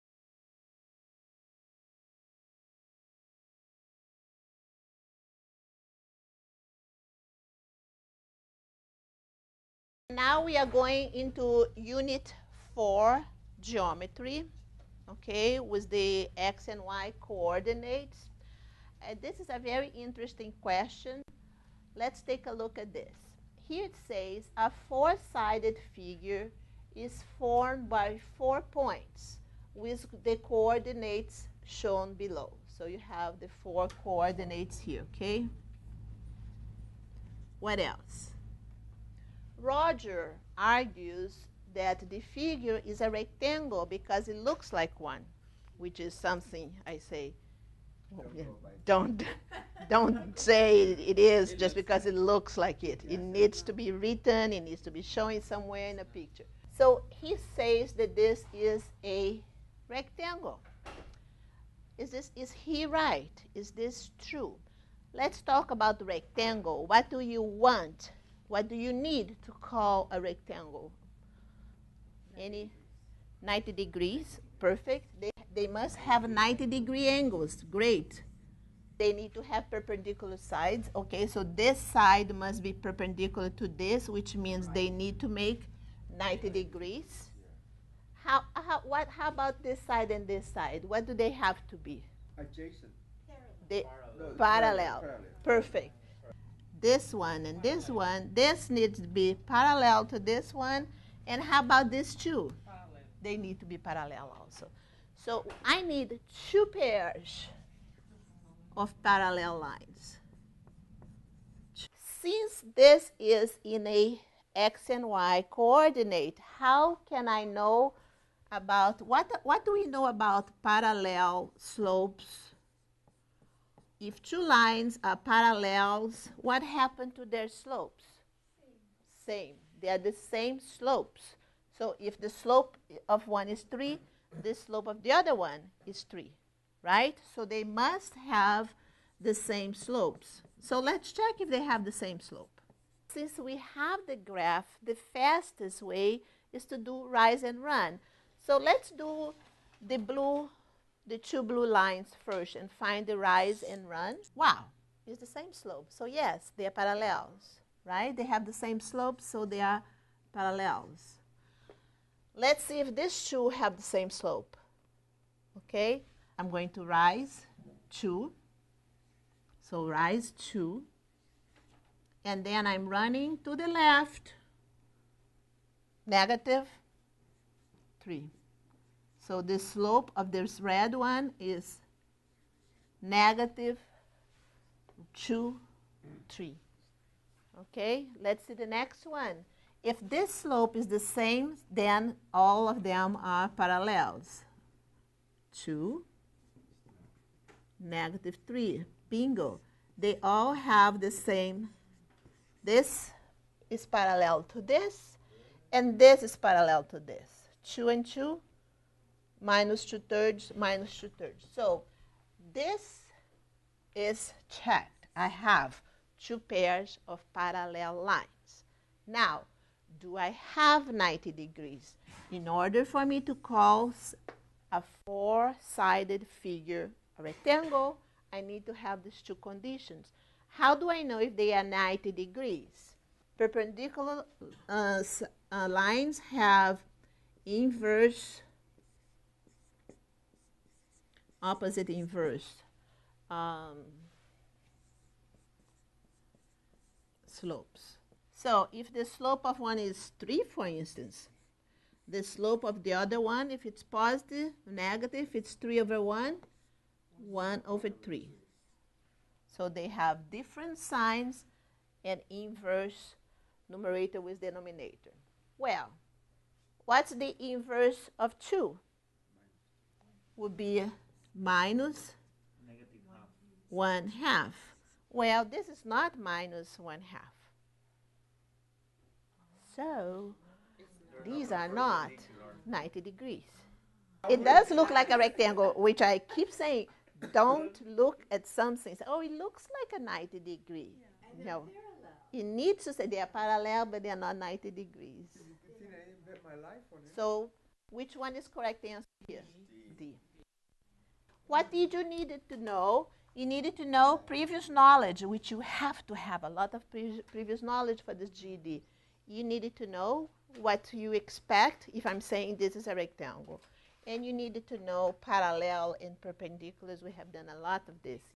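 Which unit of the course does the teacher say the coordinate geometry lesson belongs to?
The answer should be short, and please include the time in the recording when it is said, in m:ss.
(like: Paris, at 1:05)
Unit 4, at 0:11.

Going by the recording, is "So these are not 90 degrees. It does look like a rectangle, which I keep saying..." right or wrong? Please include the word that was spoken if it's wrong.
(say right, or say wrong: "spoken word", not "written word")
right.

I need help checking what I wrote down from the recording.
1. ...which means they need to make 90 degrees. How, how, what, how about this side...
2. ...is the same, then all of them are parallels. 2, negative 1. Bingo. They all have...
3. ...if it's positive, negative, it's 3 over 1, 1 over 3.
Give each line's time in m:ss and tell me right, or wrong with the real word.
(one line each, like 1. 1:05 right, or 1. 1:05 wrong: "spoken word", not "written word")
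1. 1:24 right
2. 3:10 wrong: "3", not "1"
3. 4:13 right.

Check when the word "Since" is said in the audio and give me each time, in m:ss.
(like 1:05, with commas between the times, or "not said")
1:52, 2:23.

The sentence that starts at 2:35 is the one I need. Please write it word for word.
So yes, they are parallels, right?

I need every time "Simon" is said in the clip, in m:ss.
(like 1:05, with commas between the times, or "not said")
not said.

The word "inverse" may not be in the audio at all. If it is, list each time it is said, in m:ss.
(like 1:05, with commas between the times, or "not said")
3:57, 4:01, 4:22, 4:27.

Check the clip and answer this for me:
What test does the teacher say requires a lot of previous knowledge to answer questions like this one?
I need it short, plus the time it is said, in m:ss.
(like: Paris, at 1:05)
GED, at 5:08.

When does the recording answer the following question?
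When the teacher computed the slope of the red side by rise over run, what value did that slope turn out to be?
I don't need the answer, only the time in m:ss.
3:03.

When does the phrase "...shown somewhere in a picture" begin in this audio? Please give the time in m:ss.
0:55.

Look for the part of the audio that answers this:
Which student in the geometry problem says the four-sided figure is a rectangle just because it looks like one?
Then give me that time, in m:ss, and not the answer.
0:39.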